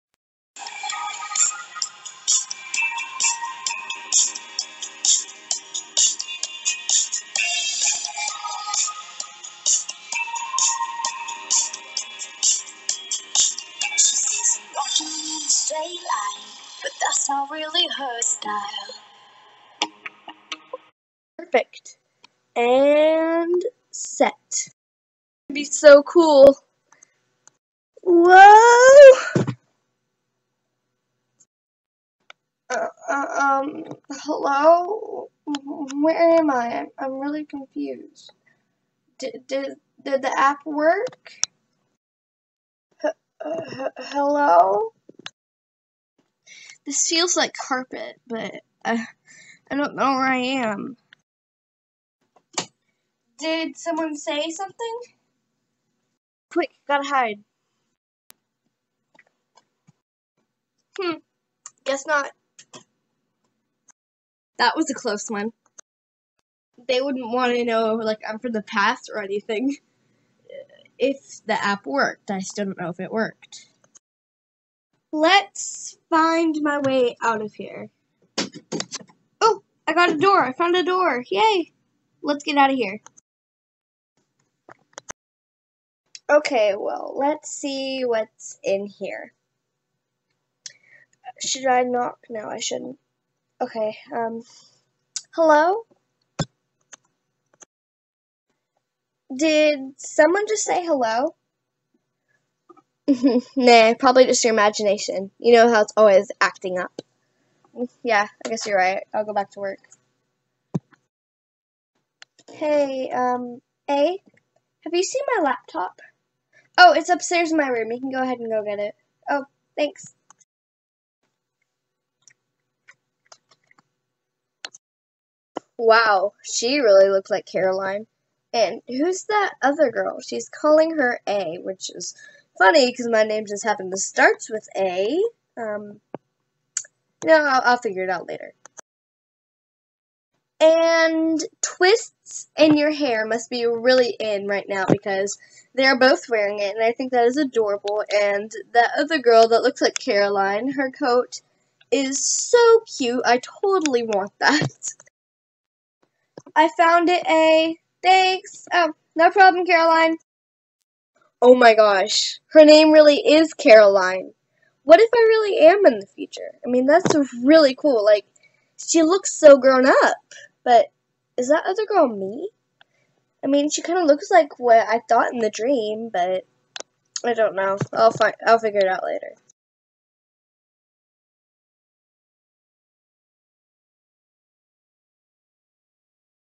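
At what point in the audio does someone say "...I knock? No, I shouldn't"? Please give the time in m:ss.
1:31.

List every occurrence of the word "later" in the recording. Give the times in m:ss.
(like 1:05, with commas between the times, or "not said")
2:18, 2:59.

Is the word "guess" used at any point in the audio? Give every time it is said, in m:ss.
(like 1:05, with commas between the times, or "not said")
1:01, 1:48.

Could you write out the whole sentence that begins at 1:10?
If the app worked, I still don't know if it worked.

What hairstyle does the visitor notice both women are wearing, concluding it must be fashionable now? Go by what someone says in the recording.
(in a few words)
Twists.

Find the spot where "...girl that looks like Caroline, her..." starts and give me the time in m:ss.
2:29.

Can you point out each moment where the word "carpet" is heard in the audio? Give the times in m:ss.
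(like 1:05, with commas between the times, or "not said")
0:47.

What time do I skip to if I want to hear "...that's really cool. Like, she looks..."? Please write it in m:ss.
2:46.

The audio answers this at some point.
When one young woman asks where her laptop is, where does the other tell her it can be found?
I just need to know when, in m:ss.
1:57.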